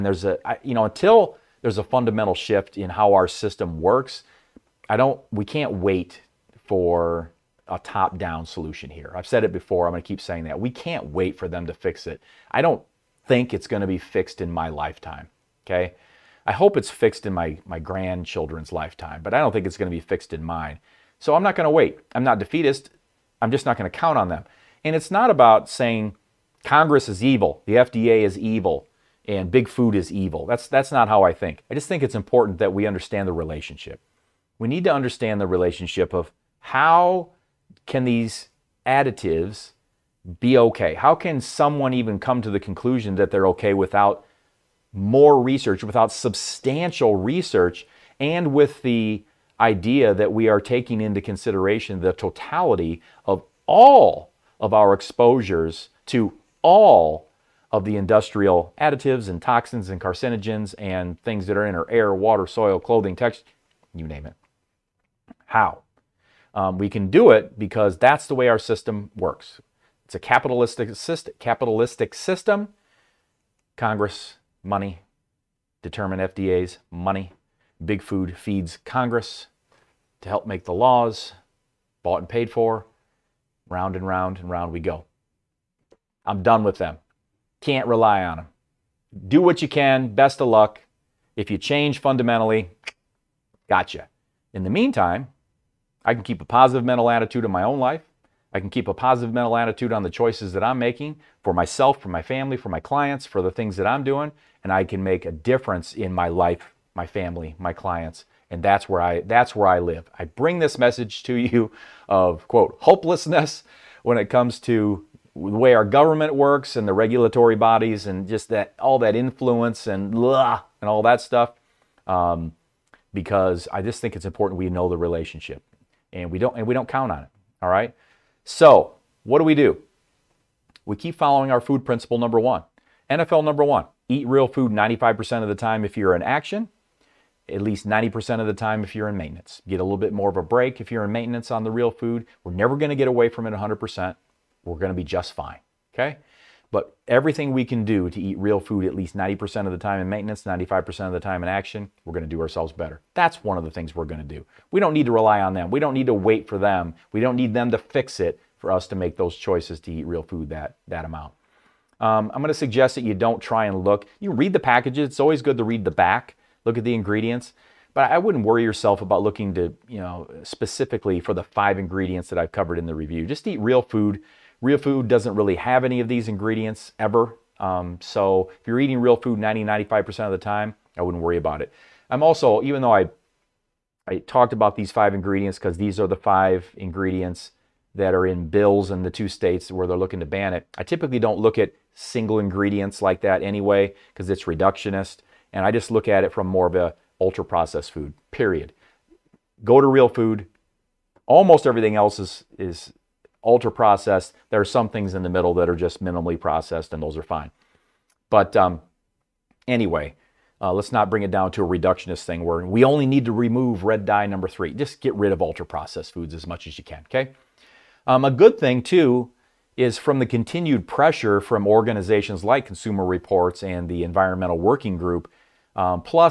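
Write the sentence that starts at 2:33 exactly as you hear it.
That's one of the things we're going to do.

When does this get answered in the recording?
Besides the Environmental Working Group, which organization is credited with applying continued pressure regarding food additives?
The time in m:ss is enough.
3:42.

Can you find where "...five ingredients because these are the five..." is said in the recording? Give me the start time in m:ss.
3:04.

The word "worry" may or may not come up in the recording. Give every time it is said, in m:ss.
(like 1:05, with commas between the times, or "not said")
2:48, 3:01.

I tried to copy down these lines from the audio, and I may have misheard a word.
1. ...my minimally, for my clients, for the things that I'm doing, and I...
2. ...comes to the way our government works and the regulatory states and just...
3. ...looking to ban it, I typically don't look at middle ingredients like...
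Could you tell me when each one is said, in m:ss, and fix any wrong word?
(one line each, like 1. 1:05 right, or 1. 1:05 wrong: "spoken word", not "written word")
1. 1:42 wrong: "family", not "minimally"
2. 1:54 wrong: "bodies", not "states"
3. 3:09 wrong: "single", not "middle".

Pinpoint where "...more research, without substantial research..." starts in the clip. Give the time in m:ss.
0:44.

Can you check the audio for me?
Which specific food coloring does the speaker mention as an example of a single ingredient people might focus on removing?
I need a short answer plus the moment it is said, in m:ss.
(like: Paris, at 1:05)
Red dye number 3, at 3:33.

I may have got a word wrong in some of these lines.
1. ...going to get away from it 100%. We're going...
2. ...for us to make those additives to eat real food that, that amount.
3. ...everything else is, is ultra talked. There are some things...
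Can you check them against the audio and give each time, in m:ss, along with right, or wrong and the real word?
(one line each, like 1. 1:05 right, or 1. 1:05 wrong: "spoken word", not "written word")
1. 2:22 right
2. 2:38 wrong: "choices", not "additives"
3. 3:21 wrong: "processed", not "talked".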